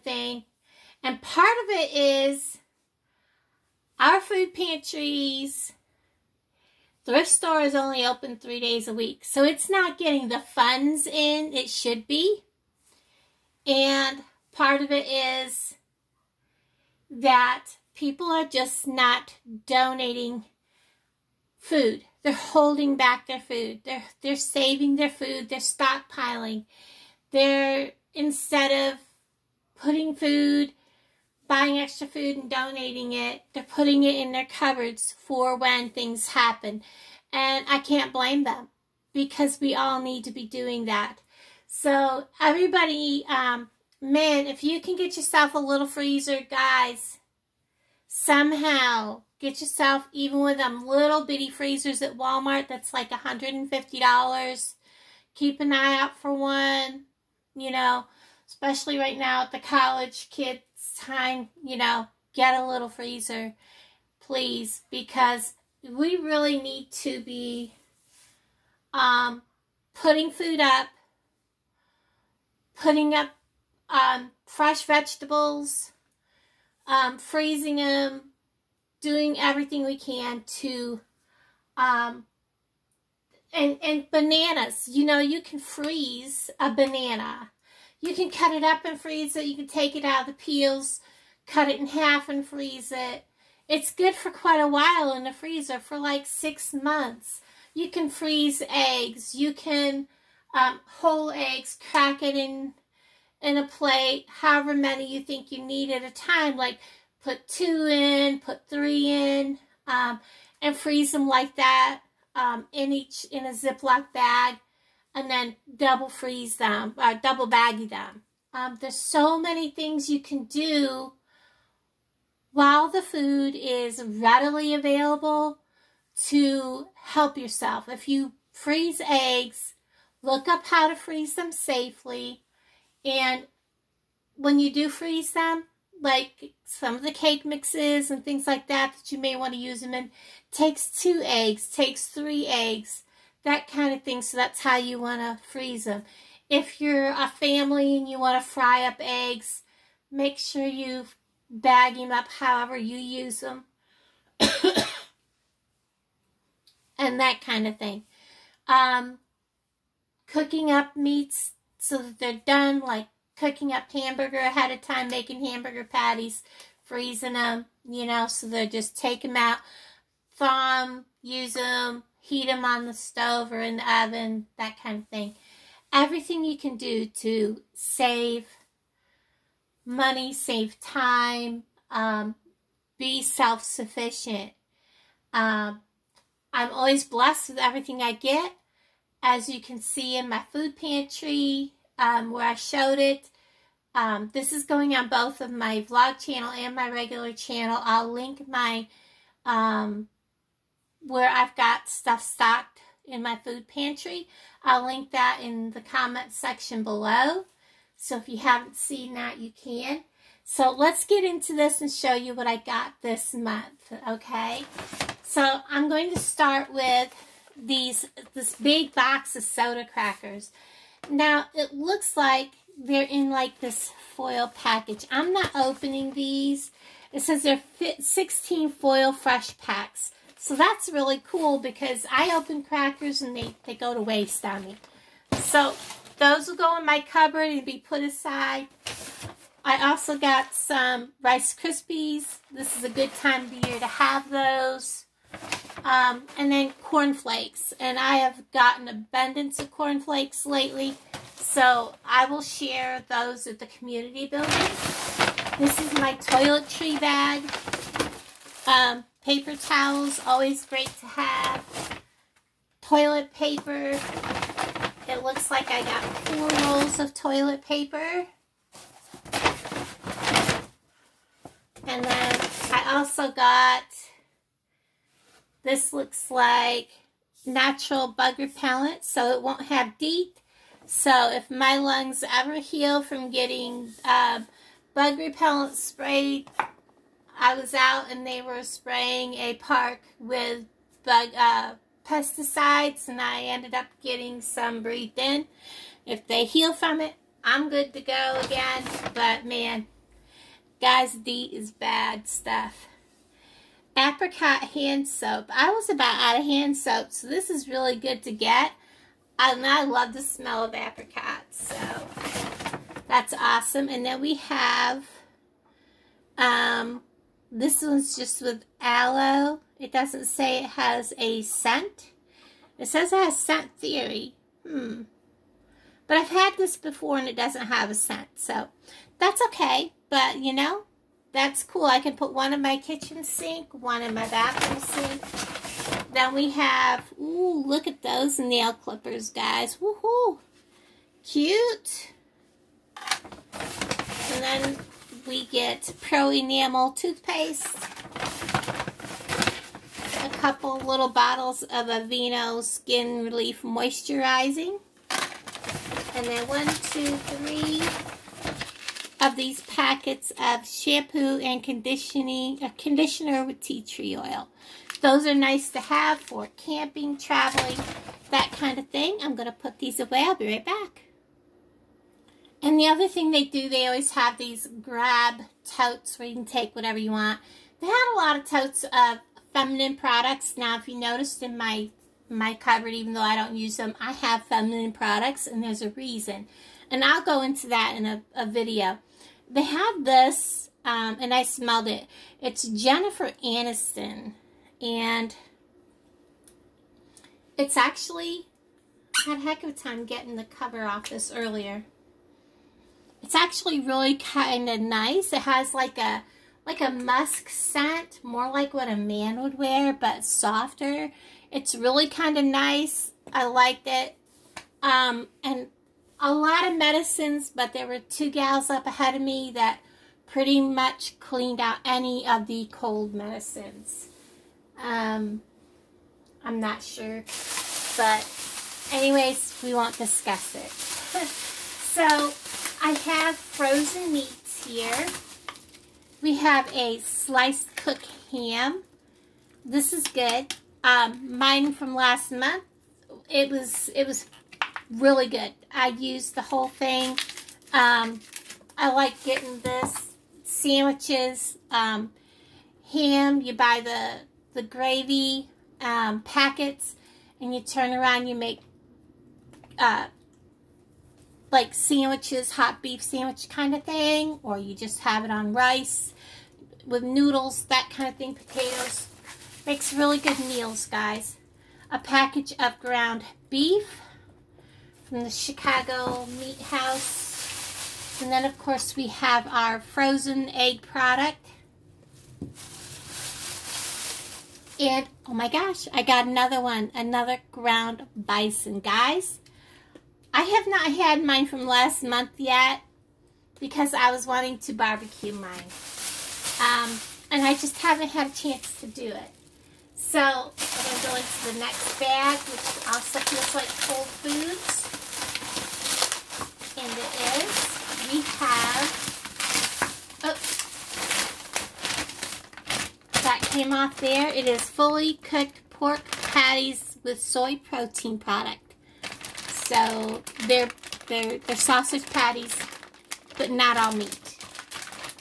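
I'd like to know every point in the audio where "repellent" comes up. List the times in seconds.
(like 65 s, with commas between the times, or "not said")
278 s, 285 s.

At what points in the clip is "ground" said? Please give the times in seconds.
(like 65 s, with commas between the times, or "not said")
472 s, 487 s.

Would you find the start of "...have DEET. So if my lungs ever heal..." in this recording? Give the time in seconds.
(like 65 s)
279 s.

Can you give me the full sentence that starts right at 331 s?
I can put one in my kitchen sink, one in my bathroom sink.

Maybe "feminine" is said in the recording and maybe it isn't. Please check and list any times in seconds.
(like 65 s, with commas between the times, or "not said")
379 s, 384 s.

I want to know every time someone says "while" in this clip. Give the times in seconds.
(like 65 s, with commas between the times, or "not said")
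94 s, 122 s.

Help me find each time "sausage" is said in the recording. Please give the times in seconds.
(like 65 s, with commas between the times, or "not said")
521 s.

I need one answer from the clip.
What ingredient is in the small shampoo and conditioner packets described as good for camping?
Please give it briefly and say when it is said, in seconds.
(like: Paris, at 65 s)
tea tree oil, at 363 s.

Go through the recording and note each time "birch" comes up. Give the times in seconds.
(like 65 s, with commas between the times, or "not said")
not said.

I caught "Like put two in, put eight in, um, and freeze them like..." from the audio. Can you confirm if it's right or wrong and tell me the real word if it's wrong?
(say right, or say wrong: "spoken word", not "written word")
wrong: "three", not "eight".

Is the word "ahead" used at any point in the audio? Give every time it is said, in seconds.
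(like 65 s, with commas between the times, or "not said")
164 s, 418 s.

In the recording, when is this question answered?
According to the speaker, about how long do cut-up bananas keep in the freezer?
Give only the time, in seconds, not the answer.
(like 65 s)
96 s.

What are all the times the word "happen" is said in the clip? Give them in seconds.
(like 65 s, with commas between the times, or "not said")
36 s.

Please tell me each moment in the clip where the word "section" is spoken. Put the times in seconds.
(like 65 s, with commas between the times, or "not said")
206 s.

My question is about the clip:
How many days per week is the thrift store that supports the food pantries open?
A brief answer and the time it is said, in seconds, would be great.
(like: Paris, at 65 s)
3, at 8 s.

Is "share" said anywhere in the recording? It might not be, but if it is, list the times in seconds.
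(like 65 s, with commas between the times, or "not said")
252 s.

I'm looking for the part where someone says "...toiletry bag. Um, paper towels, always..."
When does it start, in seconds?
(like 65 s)
256 s.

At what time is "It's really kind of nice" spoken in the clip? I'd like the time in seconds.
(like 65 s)
411 s.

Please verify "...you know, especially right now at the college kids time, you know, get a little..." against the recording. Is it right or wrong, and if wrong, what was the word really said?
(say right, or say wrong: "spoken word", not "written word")
right.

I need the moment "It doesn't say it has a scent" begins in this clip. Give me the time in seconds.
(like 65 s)
319 s.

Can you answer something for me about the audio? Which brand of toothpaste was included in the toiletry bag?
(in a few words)
Pronamel.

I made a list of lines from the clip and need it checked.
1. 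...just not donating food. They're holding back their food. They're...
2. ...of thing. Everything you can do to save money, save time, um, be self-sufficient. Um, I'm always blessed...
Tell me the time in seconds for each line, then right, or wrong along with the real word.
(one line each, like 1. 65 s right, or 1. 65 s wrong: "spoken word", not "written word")
1. 18 s right
2. 174 s right.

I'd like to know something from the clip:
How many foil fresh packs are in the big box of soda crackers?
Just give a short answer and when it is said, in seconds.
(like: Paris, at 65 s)
16, at 227 s.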